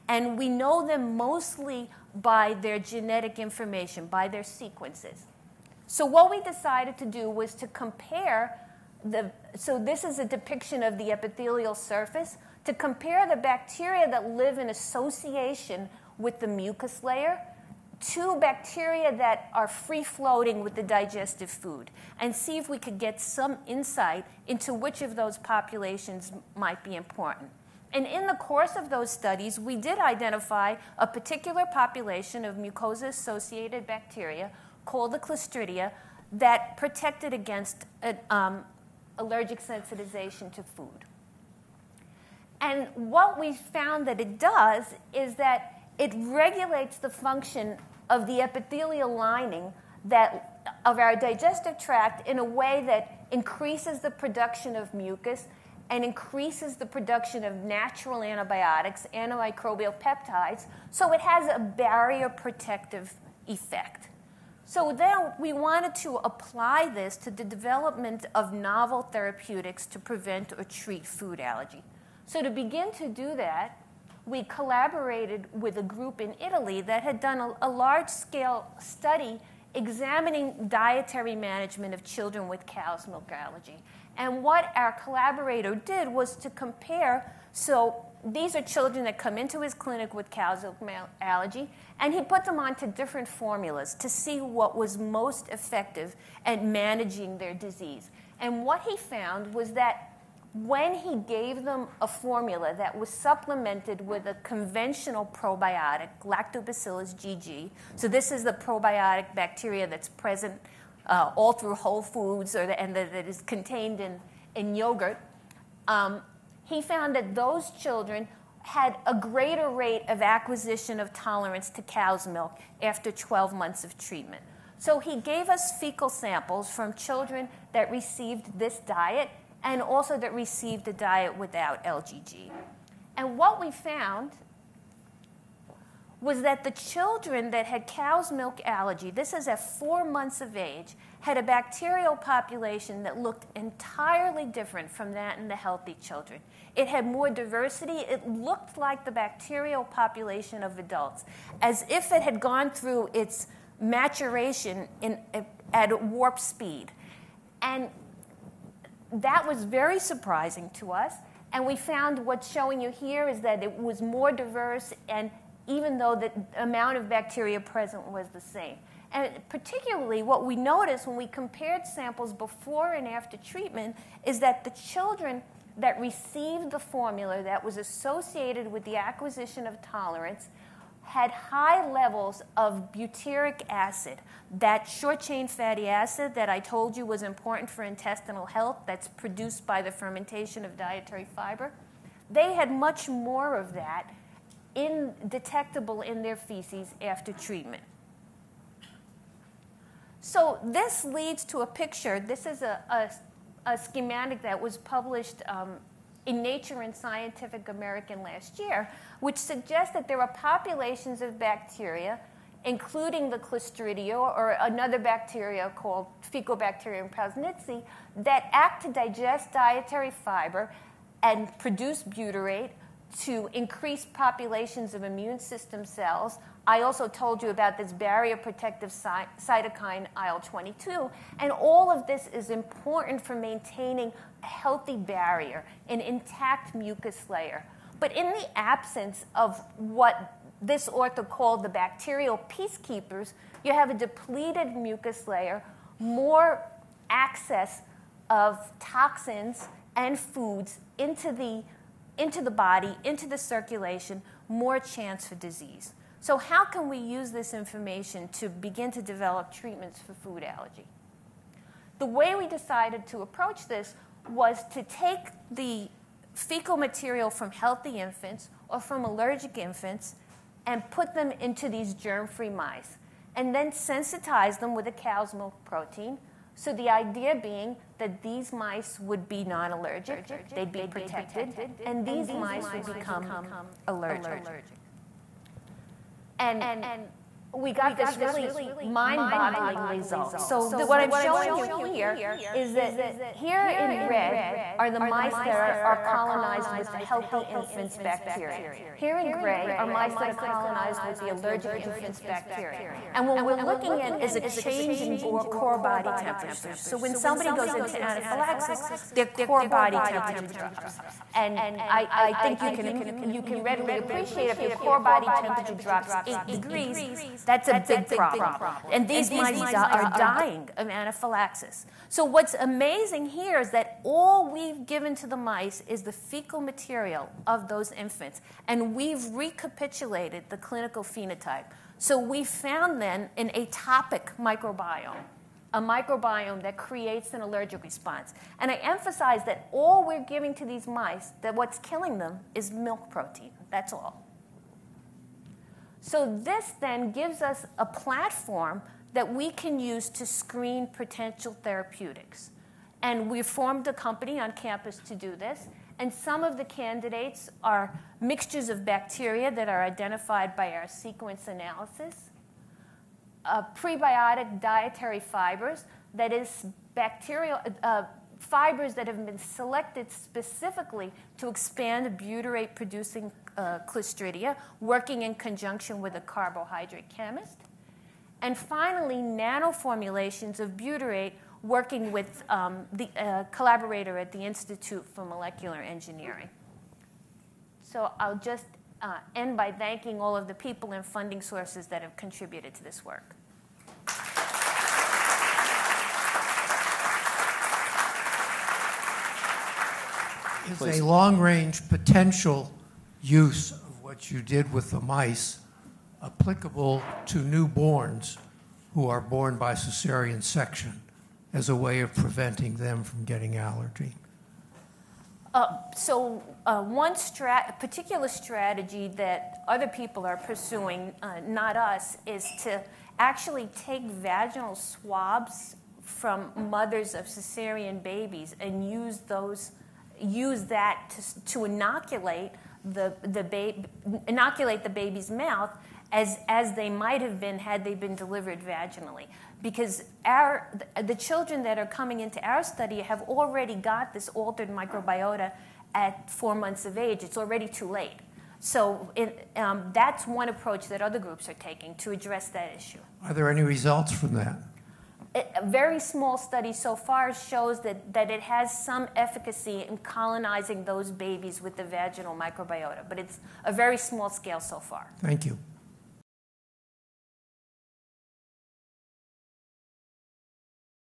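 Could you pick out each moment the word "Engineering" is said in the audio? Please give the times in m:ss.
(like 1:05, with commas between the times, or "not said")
6:25.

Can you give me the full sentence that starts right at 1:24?
And what our collaborator did was to compare.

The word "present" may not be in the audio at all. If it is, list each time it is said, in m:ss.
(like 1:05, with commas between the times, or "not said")
1:50, 2:47.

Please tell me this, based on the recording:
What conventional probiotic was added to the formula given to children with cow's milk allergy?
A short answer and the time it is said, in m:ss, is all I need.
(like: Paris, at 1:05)
Lactobacillus GG, at 1:46.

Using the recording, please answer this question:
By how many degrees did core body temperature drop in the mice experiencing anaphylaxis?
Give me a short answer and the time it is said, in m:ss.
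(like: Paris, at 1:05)
8, at 5:16.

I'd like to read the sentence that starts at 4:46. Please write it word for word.
And we got this really mind-boggling result.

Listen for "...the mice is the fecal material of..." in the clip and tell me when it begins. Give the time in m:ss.
5:25.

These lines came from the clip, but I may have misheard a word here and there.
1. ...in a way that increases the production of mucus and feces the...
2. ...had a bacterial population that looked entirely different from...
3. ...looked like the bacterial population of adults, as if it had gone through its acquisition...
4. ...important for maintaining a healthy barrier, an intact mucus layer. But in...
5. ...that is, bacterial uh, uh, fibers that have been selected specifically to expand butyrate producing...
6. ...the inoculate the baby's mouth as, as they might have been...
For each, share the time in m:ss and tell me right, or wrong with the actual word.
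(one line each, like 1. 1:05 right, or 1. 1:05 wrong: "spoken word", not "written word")
1. 0:52 wrong: "increases", not "feces"
2. 2:21 right
3. 2:28 wrong: "maturation", not "acquisition"
4. 3:52 right
5. 6:06 right
6. 7:13 right.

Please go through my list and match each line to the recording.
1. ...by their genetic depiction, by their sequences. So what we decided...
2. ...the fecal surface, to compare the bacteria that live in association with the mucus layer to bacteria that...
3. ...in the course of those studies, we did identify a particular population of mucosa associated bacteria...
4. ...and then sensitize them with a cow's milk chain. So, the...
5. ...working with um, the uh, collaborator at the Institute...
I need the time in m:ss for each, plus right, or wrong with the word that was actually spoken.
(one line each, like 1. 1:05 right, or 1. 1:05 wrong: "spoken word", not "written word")
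1. 0:02 wrong: "information", not "depiction"
2. 0:10 wrong: "epithelial", not "fecal"
3. 0:28 right
4. 4:33 wrong: "protein", not "chain"
5. 6:21 right.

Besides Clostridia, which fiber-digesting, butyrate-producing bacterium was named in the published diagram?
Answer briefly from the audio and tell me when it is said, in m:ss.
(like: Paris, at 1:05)
Faecalibacterium prausnitzii, at 3:36.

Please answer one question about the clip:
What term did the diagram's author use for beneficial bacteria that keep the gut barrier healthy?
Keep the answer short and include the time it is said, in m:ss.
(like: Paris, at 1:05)
bacterial peacekeepers, at 4:01.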